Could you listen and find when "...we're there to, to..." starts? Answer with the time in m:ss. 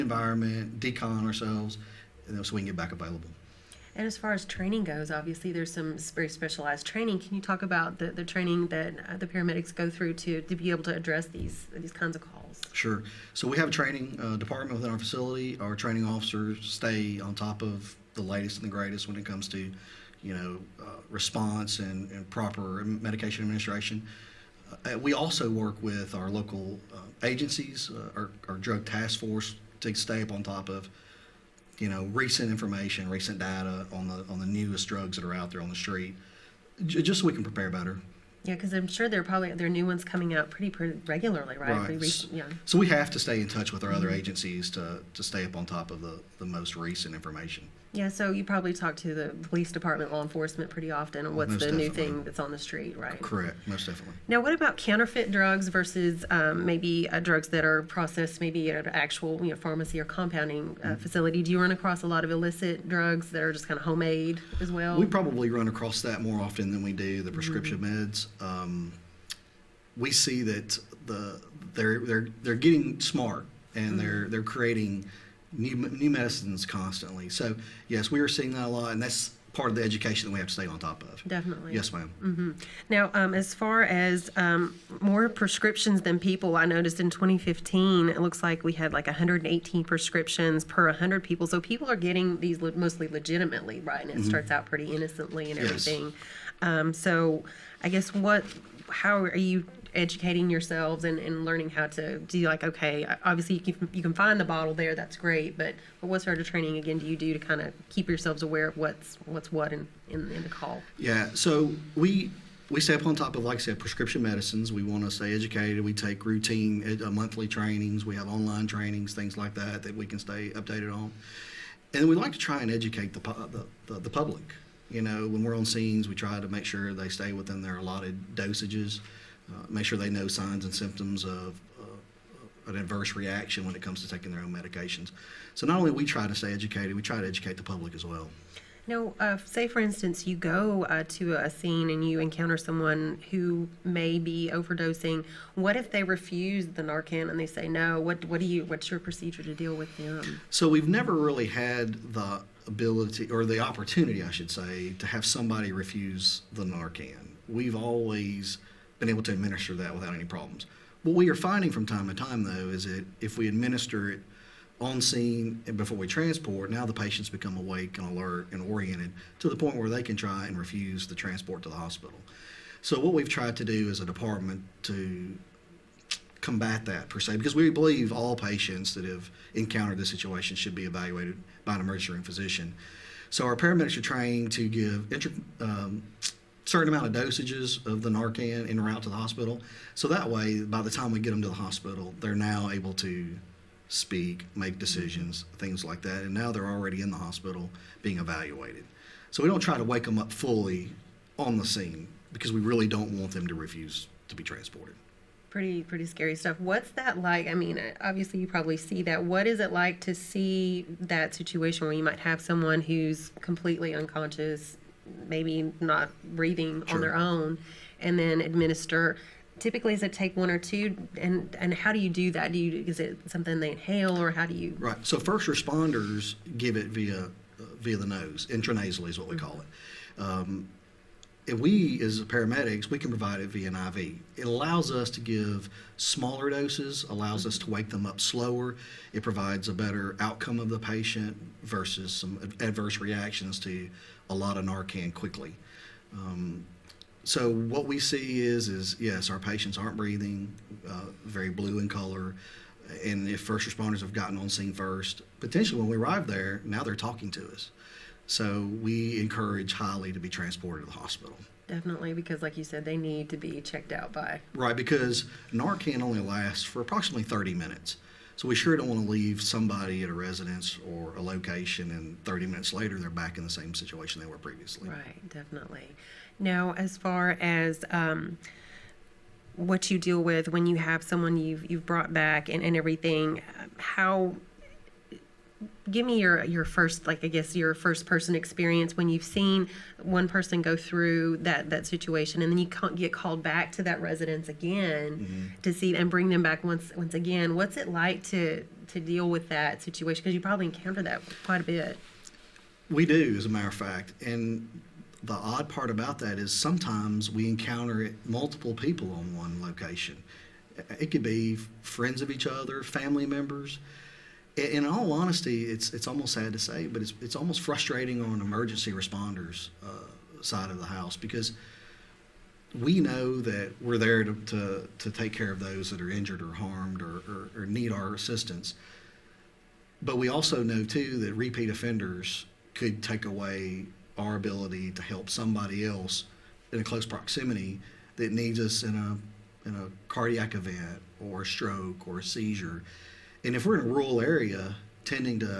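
5:23.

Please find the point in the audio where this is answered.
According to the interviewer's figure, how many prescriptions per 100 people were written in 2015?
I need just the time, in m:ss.
1:29.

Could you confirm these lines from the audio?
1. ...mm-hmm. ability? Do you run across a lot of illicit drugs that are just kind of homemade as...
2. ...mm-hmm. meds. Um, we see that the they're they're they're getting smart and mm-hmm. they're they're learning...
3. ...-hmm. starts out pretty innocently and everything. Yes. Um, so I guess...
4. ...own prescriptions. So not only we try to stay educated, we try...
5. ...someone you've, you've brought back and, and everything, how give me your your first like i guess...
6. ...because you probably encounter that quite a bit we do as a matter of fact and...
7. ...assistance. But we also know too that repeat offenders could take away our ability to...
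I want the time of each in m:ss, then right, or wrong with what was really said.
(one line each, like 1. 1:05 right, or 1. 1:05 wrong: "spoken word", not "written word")
1. 1:00 wrong: "facility", not "ability"
2. 1:07 wrong: "creating", not "learning"
3. 1:34 right
4. 2:14 wrong: "medications", not "prescriptions"
5. 4:41 right
6. 5:00 right
7. 5:28 right.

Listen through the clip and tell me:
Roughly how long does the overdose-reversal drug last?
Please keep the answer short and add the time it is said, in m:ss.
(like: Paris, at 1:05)
30 minutes, at 4:26.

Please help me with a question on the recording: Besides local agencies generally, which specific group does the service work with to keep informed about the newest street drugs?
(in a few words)
drug task force.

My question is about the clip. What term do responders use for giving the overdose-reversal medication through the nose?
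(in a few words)
intranasally.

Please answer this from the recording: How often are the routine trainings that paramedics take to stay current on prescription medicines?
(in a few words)
monthly.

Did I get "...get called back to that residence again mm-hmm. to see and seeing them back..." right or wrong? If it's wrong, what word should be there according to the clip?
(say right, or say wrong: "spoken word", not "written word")
wrong: "bring", not "seeing".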